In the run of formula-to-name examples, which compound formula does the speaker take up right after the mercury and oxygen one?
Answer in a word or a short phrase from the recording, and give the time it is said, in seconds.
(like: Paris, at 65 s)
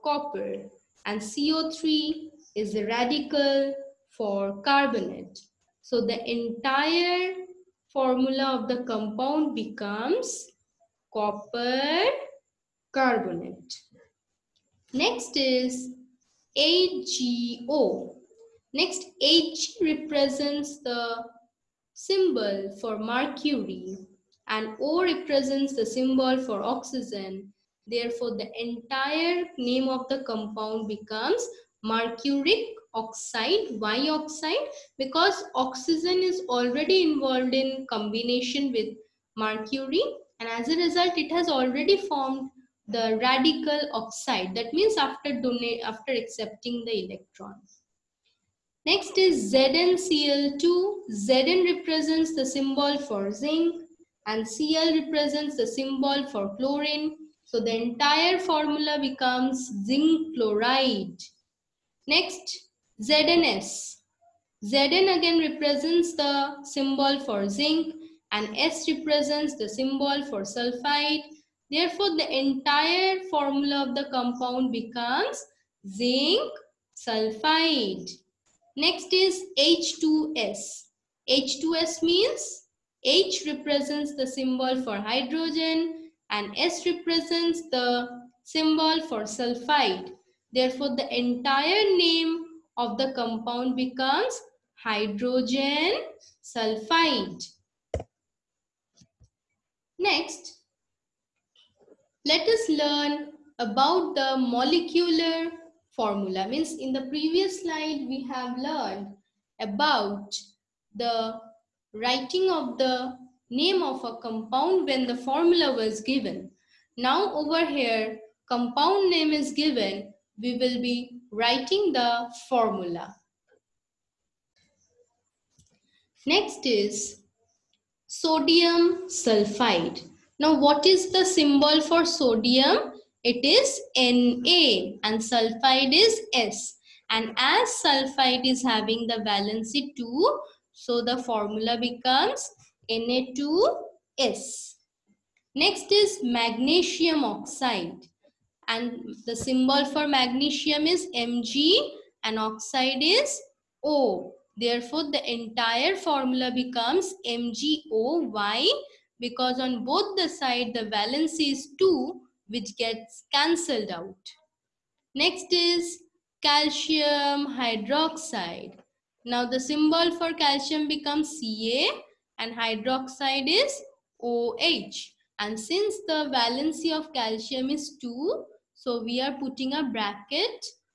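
ZnCl2, at 49 s.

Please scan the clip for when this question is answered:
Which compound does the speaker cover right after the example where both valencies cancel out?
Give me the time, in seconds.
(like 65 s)
166 s.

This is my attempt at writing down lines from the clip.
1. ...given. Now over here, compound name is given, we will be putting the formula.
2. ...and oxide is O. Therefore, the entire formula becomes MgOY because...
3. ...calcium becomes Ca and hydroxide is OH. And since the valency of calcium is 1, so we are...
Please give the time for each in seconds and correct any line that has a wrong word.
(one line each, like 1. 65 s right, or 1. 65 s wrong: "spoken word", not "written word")
1. 116 s wrong: "writing", not "putting"
2. 152 s right
3. 170 s wrong: "2", not "1".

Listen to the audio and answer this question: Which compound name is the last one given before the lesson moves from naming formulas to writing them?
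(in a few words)
hydrogen sulfide.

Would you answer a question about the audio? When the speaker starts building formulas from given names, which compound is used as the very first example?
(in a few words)
sodium sulfide.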